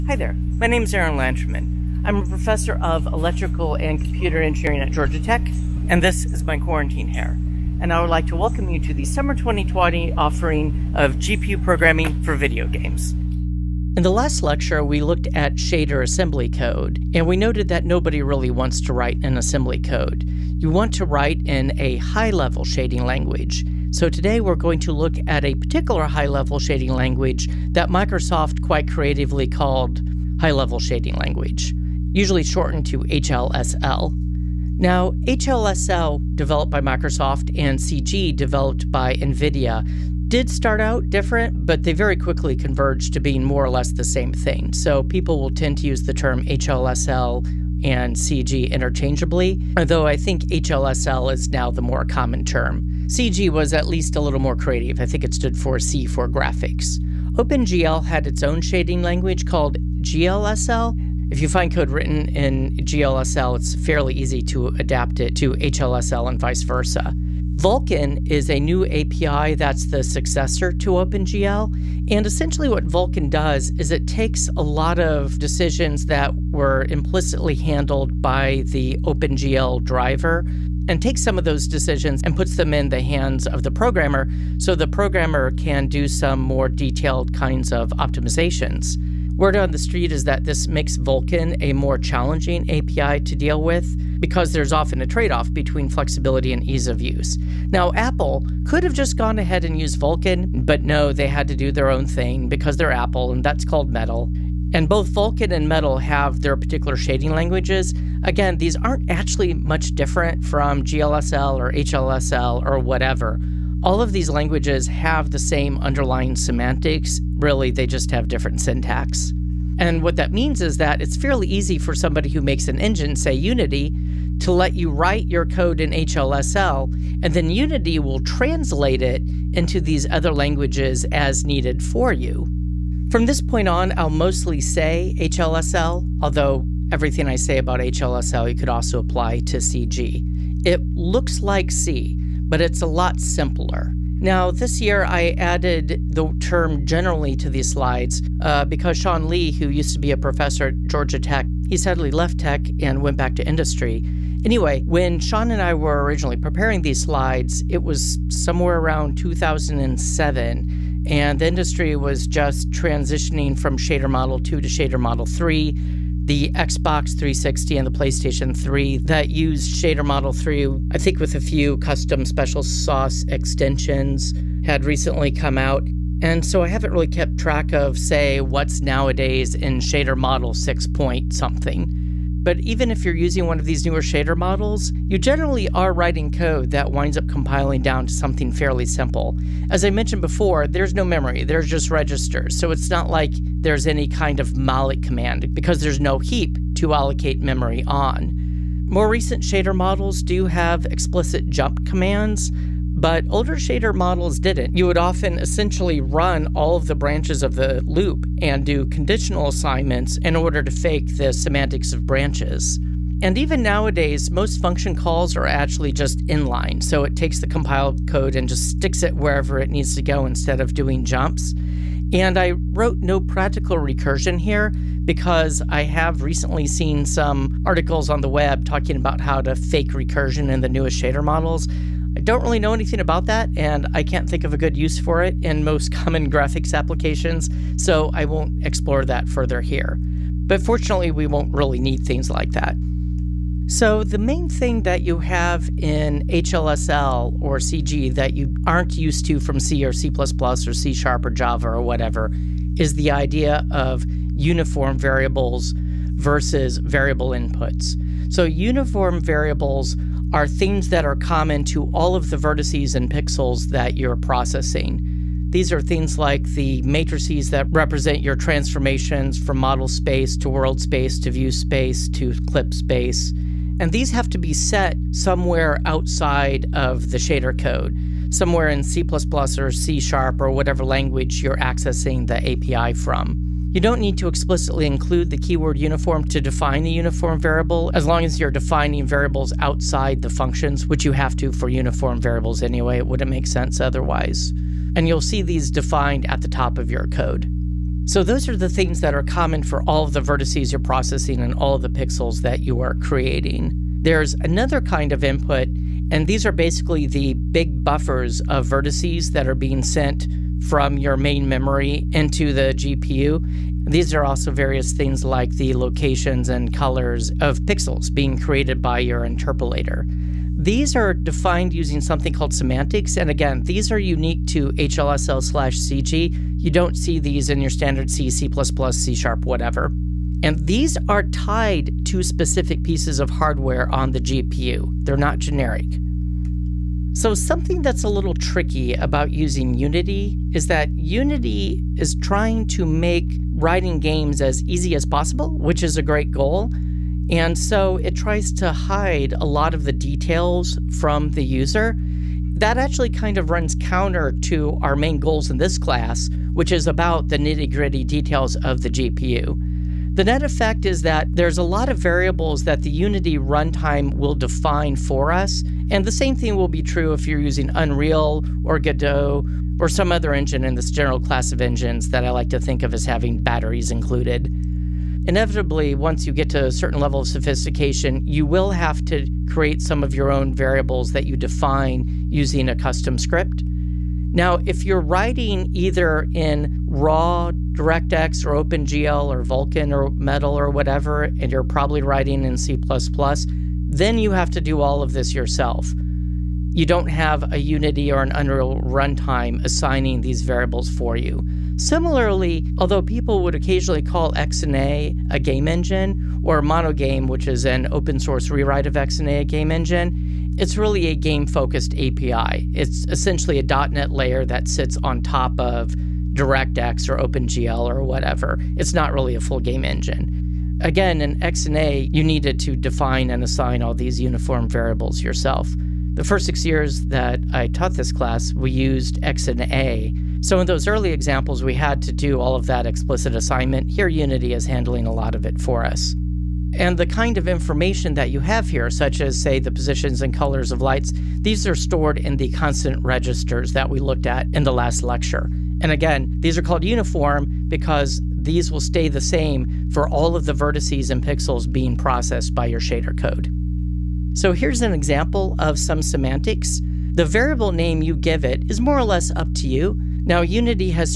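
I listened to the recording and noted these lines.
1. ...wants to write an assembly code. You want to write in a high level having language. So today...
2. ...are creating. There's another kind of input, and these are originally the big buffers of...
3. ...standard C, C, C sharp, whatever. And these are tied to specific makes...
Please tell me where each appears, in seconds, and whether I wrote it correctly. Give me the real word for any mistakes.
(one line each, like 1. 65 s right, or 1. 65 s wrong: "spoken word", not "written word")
1. 18 s wrong: "shading", not "having"
2. 302 s wrong: "basically", not "originally"
3. 327 s wrong: "pieces", not "makes".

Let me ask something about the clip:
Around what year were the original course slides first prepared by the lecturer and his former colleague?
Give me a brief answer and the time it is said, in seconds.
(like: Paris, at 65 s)
2007, at 159 s.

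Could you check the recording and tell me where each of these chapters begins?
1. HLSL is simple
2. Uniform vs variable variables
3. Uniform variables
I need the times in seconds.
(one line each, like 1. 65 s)
1. 132 s
2. 242 s
3. 336 s.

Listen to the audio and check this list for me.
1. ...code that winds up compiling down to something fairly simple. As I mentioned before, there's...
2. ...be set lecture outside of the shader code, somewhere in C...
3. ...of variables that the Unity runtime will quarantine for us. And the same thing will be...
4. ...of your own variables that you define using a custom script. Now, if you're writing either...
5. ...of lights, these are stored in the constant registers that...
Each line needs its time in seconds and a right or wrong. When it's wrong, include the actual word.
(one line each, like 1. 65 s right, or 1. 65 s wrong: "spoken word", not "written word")
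1. 186 s right
2. 274 s wrong: "somewhere", not "lecture"
3. 361 s wrong: "define", not "quarantine"
4. 380 s right
5. 440 s right.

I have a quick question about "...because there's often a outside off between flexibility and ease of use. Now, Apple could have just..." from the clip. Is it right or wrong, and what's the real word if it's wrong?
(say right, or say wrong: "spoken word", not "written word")
wrong: "trade", not "outside".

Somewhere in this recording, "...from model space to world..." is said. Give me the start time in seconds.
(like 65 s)
269 s.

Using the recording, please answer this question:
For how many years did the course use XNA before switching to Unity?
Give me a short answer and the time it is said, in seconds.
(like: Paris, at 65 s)
6, at 426 s.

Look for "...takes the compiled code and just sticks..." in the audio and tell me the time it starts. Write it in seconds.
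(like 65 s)
217 s.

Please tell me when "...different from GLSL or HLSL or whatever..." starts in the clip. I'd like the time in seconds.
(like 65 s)
109 s.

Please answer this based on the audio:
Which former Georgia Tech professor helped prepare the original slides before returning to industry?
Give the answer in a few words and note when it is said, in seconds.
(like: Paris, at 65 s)
Sean Lee, at 148 s.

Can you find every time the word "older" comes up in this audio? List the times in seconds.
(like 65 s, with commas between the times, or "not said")
203 s.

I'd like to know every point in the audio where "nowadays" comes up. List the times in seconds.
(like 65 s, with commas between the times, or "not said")
178 s, 213 s.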